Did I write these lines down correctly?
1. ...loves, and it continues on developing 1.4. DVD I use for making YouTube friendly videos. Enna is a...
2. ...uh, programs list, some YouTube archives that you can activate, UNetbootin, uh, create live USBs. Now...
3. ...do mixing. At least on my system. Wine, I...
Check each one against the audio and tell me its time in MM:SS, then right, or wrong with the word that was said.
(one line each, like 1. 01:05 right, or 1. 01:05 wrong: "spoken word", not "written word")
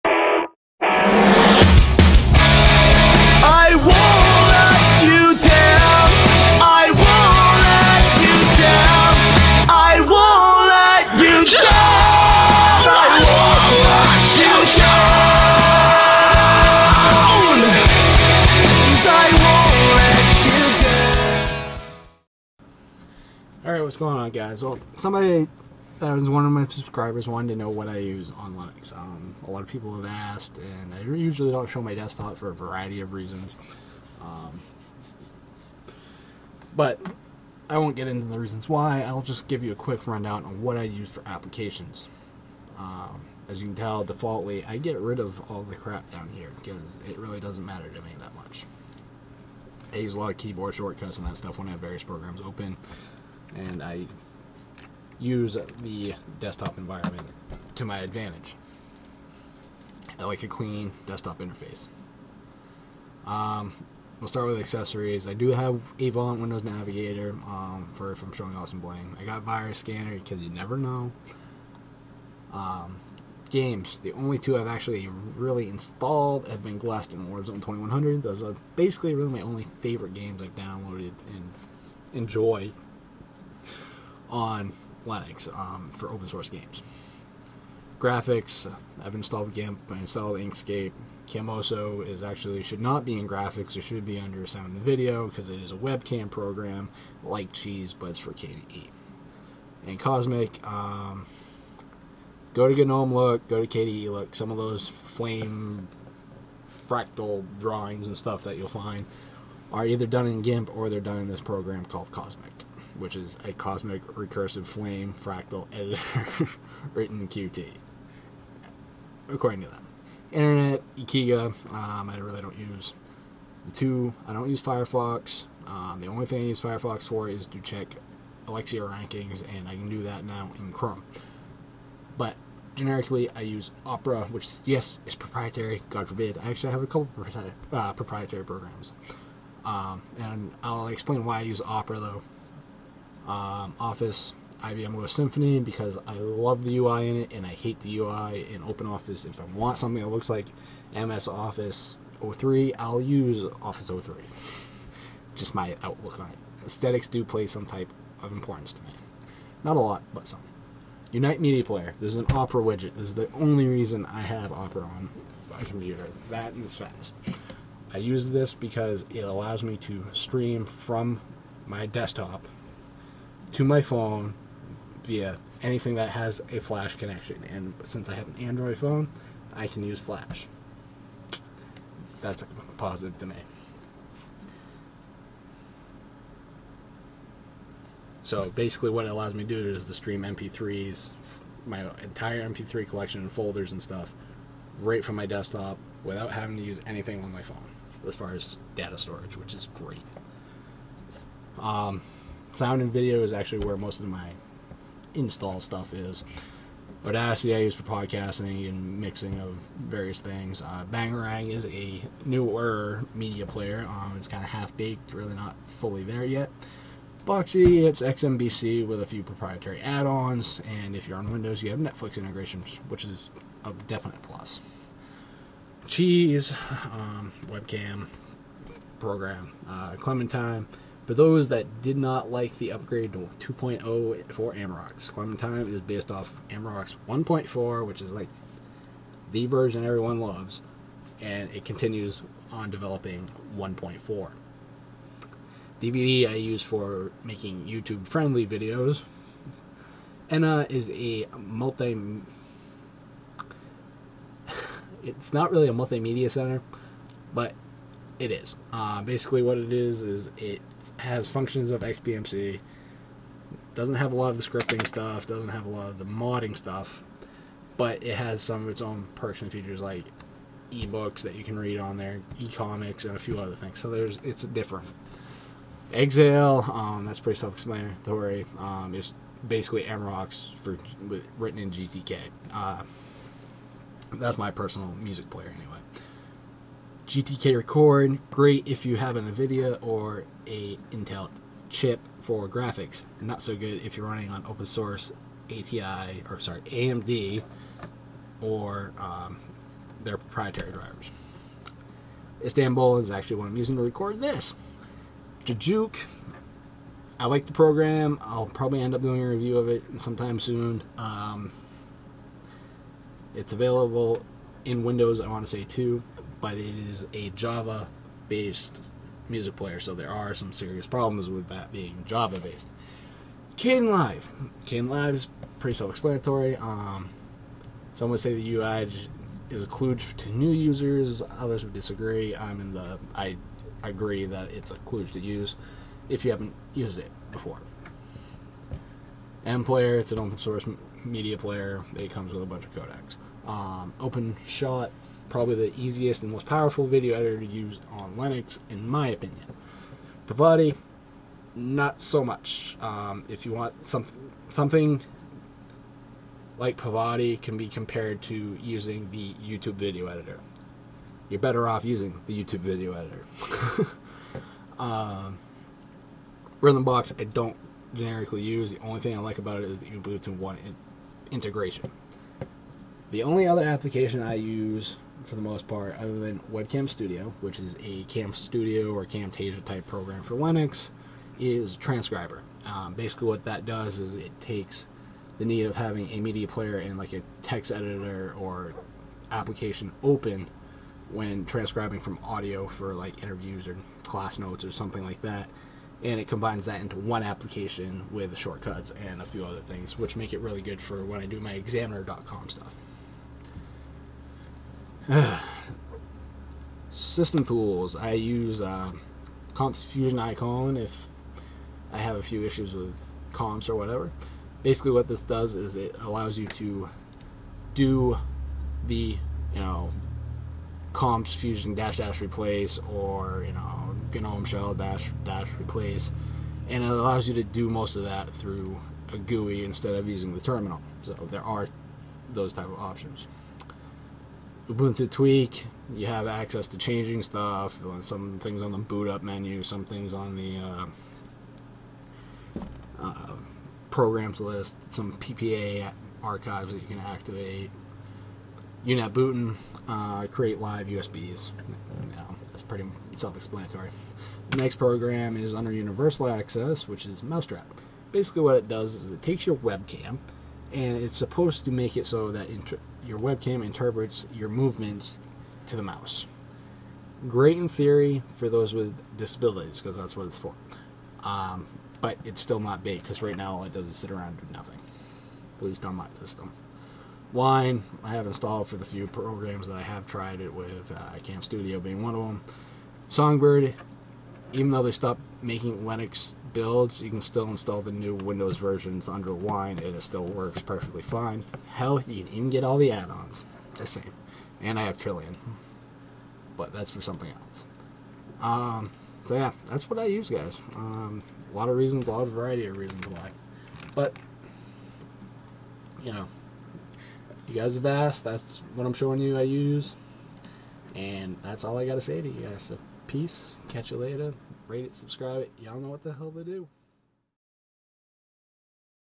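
1. 04:00 right
2. 07:23 wrong: "PPA", not "YouTube"
3. 07:54 wrong: "nothing", not "mixing".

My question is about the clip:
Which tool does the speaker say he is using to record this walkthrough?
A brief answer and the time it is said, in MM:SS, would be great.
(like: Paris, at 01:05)
Istanbul, at 05:02.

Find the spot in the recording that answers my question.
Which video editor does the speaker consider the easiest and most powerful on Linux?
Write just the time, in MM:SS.
05:43.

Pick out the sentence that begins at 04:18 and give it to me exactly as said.
Uh, basically, what it is is it has functions of XBMC.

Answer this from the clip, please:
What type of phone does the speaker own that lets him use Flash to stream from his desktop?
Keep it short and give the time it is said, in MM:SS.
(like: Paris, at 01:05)
Android, at 02:58.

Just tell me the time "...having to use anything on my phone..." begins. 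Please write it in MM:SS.
03:16.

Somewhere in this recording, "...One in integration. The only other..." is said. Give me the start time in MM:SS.
06:10.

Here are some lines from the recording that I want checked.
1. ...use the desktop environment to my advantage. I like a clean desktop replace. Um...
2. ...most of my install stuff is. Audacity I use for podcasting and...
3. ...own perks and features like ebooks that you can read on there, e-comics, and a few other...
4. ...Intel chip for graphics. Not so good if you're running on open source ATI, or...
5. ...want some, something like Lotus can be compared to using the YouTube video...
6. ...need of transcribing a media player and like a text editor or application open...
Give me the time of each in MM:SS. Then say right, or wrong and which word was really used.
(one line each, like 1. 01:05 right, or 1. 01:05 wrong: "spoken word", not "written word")
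1. 00:55 wrong: "interface", not "replace"
2. 03:23 right
3. 04:28 right
4. 04:50 right
5. 05:53 wrong: "Pitivi", not "Lotus"
6. 06:25 wrong: "having", not "transcribing".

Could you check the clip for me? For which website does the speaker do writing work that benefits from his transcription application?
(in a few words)
examiner.com.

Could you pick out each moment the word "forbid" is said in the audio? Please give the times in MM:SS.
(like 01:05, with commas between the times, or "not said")
02:16.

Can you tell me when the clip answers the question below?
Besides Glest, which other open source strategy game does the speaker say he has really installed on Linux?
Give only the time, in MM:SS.
01:17.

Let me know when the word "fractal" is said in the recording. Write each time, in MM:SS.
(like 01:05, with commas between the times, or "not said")
01:46, 01:55.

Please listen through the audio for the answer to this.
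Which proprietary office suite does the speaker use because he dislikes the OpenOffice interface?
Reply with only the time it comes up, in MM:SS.
02:24.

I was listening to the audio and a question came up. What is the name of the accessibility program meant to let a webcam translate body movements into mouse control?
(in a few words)
Mousetrap.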